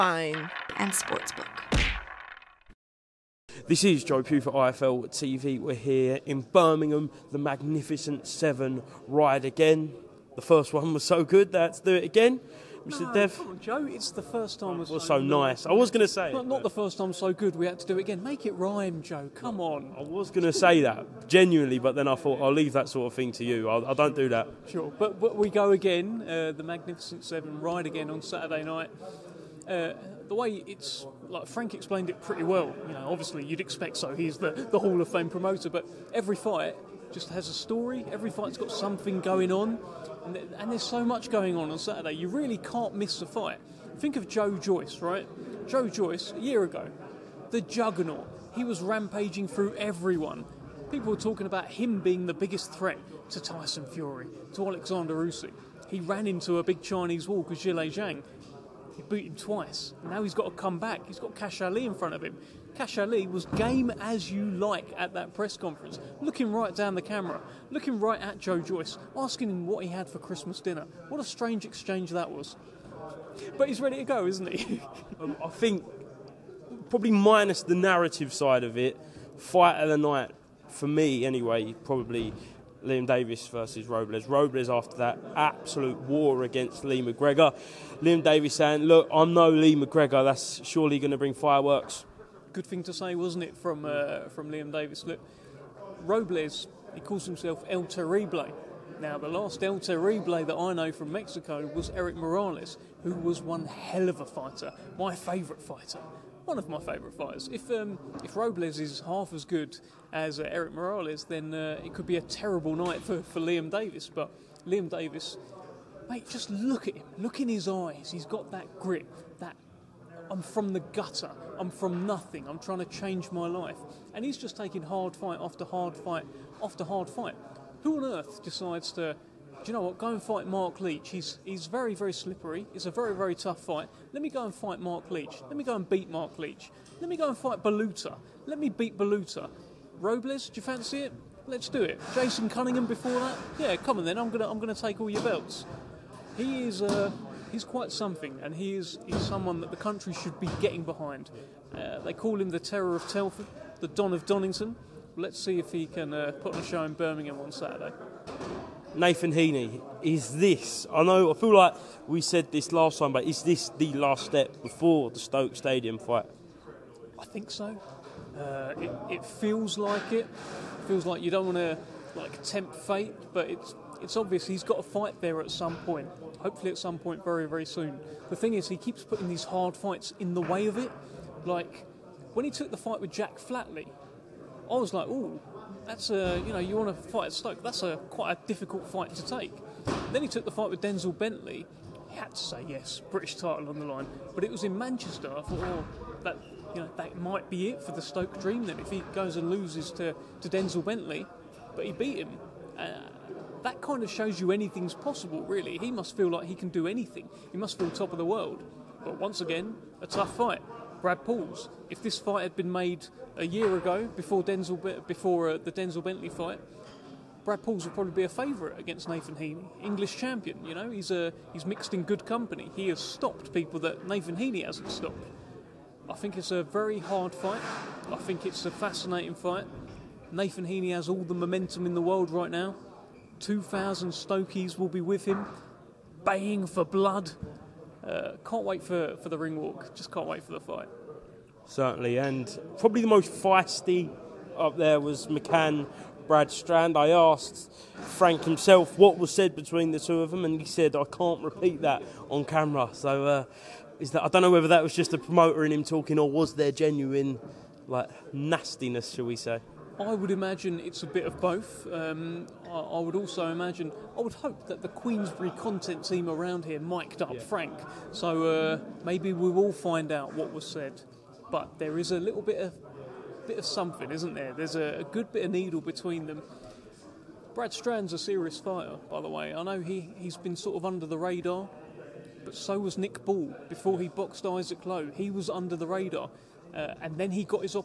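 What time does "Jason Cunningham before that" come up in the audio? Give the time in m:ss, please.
2:22.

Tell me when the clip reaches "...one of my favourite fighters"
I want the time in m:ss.
1:46.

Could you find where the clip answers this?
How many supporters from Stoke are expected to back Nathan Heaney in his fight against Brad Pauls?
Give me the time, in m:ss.
3:53.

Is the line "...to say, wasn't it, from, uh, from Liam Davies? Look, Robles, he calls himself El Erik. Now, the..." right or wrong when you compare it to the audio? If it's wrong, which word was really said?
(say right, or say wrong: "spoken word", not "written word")
wrong: "Terrible", not "Erik".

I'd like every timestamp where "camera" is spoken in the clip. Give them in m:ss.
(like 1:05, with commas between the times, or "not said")
1:07, 4:12.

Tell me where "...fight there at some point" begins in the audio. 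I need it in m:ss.
2:54.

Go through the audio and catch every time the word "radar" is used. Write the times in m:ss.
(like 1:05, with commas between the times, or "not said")
4:41, 4:45.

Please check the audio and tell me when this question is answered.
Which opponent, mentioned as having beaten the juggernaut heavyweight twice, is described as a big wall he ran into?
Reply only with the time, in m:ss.
0:57.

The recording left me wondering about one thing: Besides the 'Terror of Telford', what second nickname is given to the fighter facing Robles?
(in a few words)
the Don of Donington.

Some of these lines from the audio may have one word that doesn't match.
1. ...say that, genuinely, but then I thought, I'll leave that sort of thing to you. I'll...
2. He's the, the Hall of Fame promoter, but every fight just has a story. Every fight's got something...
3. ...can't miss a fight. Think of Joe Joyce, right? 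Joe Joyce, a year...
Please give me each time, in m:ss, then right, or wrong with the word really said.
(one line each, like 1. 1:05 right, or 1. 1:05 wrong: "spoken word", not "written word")
1. 0:20 right
2. 0:34 right
3. 0:42 right.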